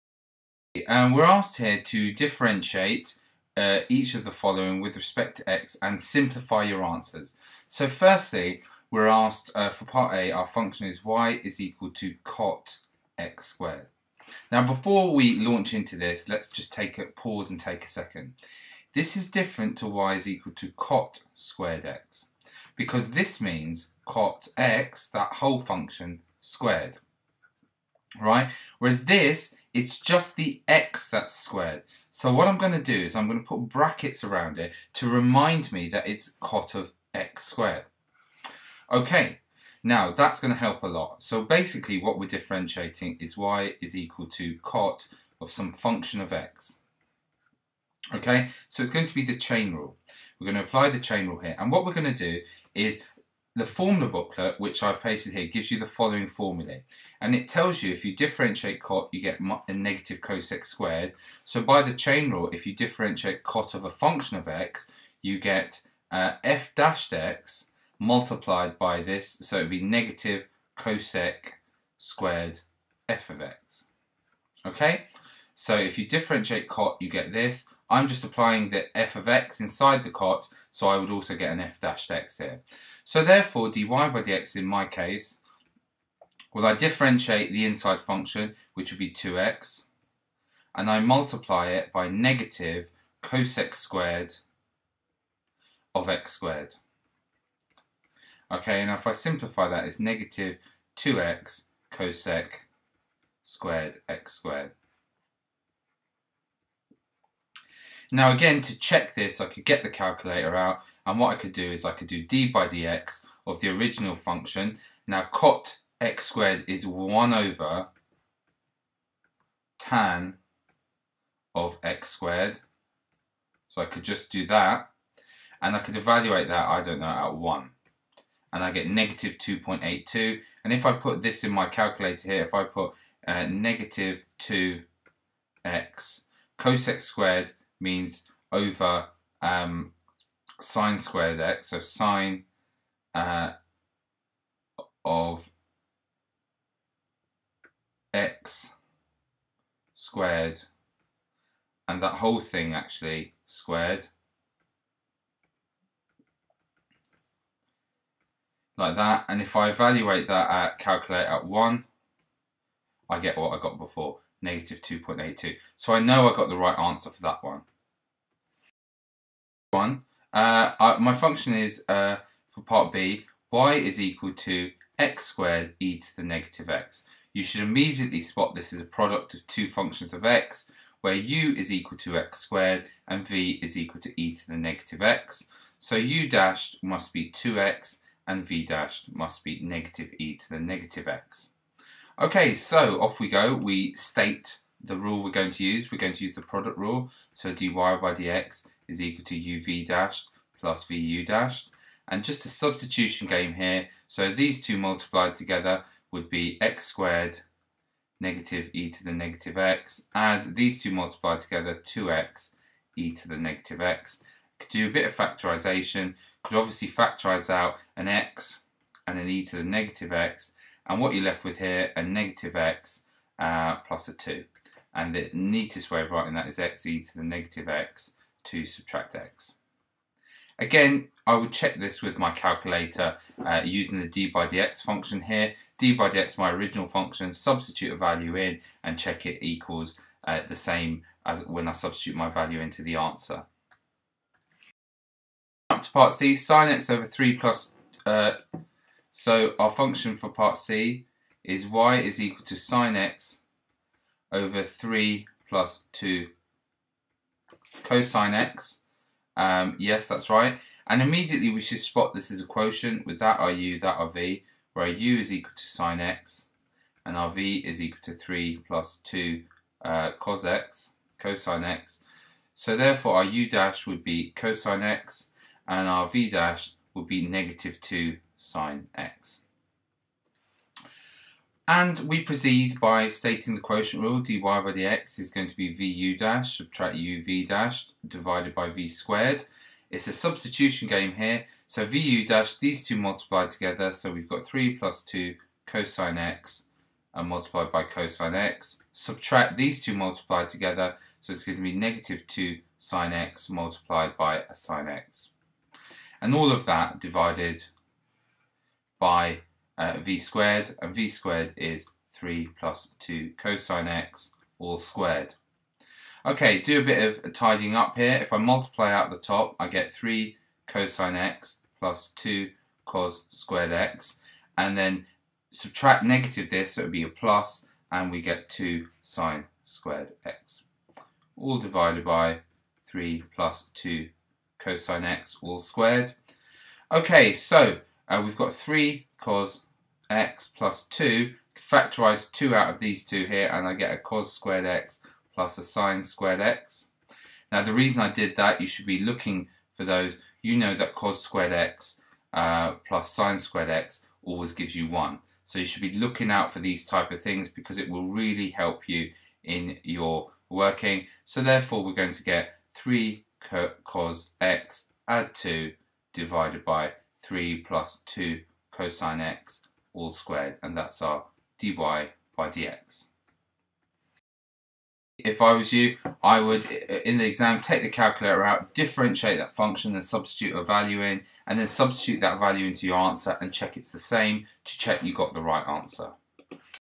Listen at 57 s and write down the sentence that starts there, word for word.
And it tells you if you differentiate cot, you get a negative cosec squared.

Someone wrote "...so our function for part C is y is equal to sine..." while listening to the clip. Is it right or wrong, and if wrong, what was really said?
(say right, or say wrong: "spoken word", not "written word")
right.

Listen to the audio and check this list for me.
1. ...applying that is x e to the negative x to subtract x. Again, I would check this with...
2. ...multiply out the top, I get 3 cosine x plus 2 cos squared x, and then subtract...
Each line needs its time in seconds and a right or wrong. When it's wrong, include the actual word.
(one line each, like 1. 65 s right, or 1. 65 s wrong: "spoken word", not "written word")
1. 226 s wrong: "writing", not "applying"
2. 318 s right.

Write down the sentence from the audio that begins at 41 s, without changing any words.
So basically what we're differentiating is y is equal to cot of some function of x.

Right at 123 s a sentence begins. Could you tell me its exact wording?
So I could just do that, and I could evaluate that, I don't know, at 1 and I get negative 2.82.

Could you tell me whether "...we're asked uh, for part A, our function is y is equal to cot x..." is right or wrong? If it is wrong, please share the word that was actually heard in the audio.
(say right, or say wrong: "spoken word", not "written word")
right.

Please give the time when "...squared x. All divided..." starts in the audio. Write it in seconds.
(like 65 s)
329 s.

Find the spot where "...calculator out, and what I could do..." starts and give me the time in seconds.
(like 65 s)
109 s.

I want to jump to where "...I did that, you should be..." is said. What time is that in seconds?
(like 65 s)
348 s.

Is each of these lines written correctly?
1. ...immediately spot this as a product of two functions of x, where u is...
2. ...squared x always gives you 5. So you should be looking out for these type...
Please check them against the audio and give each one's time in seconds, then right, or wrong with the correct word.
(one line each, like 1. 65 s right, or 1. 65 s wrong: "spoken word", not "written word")
1. 177 s right
2. 353 s wrong: "1", not "5".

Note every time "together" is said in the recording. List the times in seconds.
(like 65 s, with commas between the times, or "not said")
205 s, 211 s, 293 s, 300 s.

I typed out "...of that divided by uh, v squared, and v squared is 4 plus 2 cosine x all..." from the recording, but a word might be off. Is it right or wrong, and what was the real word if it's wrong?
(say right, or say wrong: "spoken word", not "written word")
wrong: "3", not "4".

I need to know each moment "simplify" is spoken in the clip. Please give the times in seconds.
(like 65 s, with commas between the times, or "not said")
6 s, 99 s.